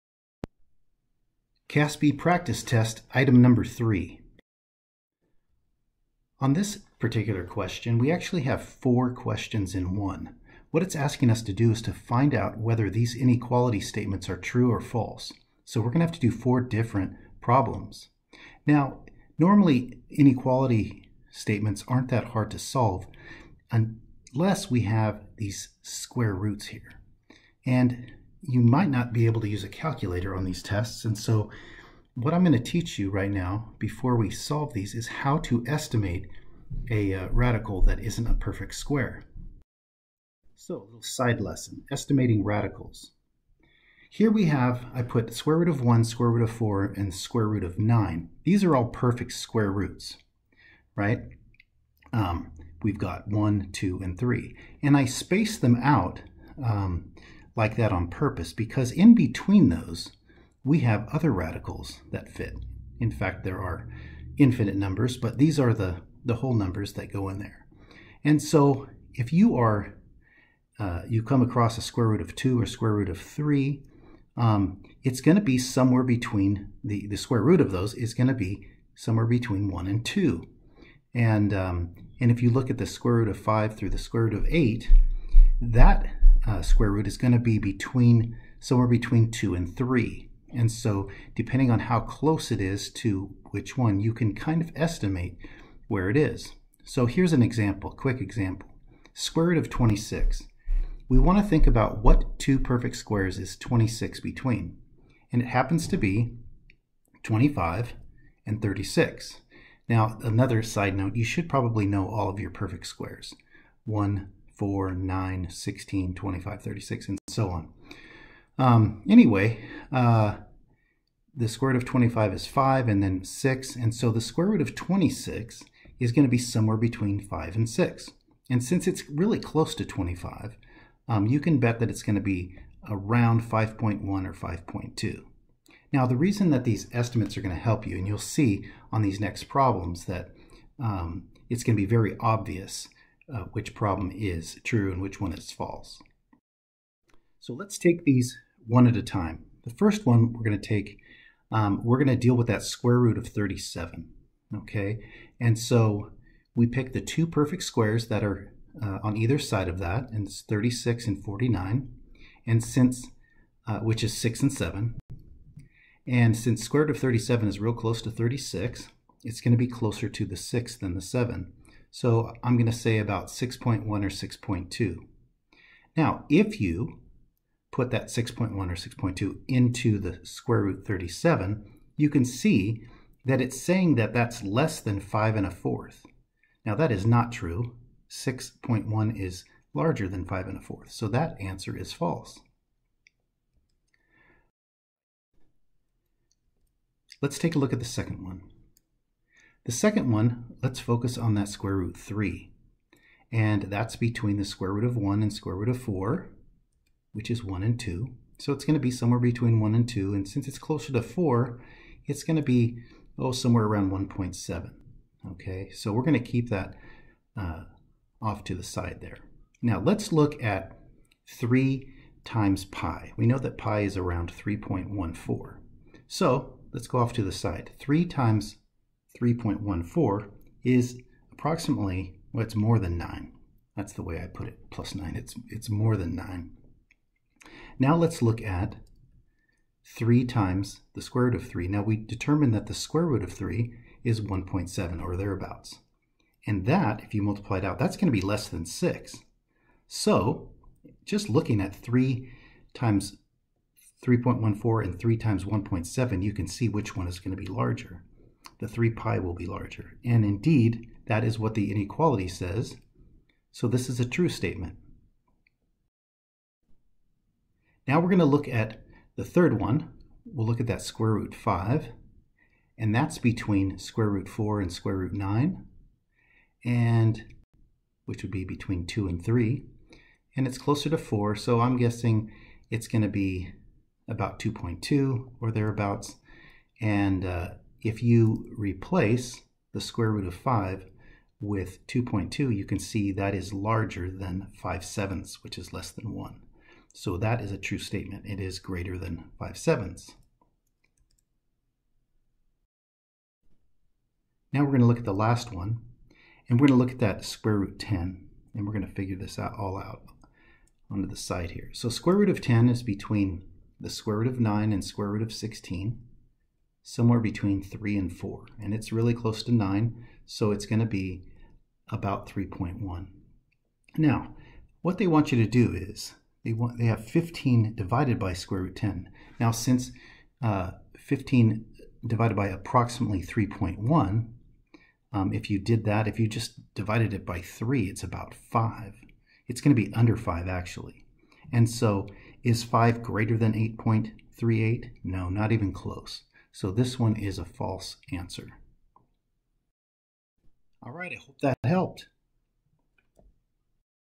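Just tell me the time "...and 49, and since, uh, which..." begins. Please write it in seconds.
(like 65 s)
161 s.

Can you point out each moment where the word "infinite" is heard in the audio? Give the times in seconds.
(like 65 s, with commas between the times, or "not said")
64 s.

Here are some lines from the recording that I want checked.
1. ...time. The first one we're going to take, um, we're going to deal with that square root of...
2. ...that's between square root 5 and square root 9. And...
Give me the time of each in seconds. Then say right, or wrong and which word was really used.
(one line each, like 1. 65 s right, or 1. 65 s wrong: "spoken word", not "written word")
1. 149 s right
2. 272 s wrong: "4", not "5".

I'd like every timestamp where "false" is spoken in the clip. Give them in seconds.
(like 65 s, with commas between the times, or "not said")
14 s, 145 s, 191 s, 347 s.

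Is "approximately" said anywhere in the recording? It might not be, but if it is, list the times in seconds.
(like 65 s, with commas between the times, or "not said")
231 s, 332 s.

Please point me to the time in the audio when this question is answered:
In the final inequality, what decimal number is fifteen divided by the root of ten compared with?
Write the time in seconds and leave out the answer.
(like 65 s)
343 s.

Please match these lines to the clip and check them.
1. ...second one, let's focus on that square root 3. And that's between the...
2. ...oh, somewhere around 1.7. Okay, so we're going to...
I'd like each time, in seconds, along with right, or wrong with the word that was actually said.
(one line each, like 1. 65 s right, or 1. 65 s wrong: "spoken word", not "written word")
1. 199 s right
2. 213 s right.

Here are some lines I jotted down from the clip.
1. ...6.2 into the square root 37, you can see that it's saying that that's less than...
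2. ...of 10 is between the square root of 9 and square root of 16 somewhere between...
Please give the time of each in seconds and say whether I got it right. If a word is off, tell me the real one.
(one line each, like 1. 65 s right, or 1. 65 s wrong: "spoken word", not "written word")
1. 178 s right
2. 312 s right.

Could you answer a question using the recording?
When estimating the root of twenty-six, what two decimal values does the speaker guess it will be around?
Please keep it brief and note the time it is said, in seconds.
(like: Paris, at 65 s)
5.1 or 5.2, at 133 s.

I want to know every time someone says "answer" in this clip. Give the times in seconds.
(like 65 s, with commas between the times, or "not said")
191 s, 348 s.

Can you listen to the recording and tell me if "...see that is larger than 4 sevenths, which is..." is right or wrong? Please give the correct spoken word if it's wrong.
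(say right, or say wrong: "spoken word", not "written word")
wrong: "5", not "4".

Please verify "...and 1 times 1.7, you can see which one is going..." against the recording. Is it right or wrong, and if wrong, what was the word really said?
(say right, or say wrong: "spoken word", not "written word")
wrong: "3", not "1".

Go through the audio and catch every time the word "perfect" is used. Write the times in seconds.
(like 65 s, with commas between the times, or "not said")
38 s, 48 s, 102 s, 112 s, 157 s.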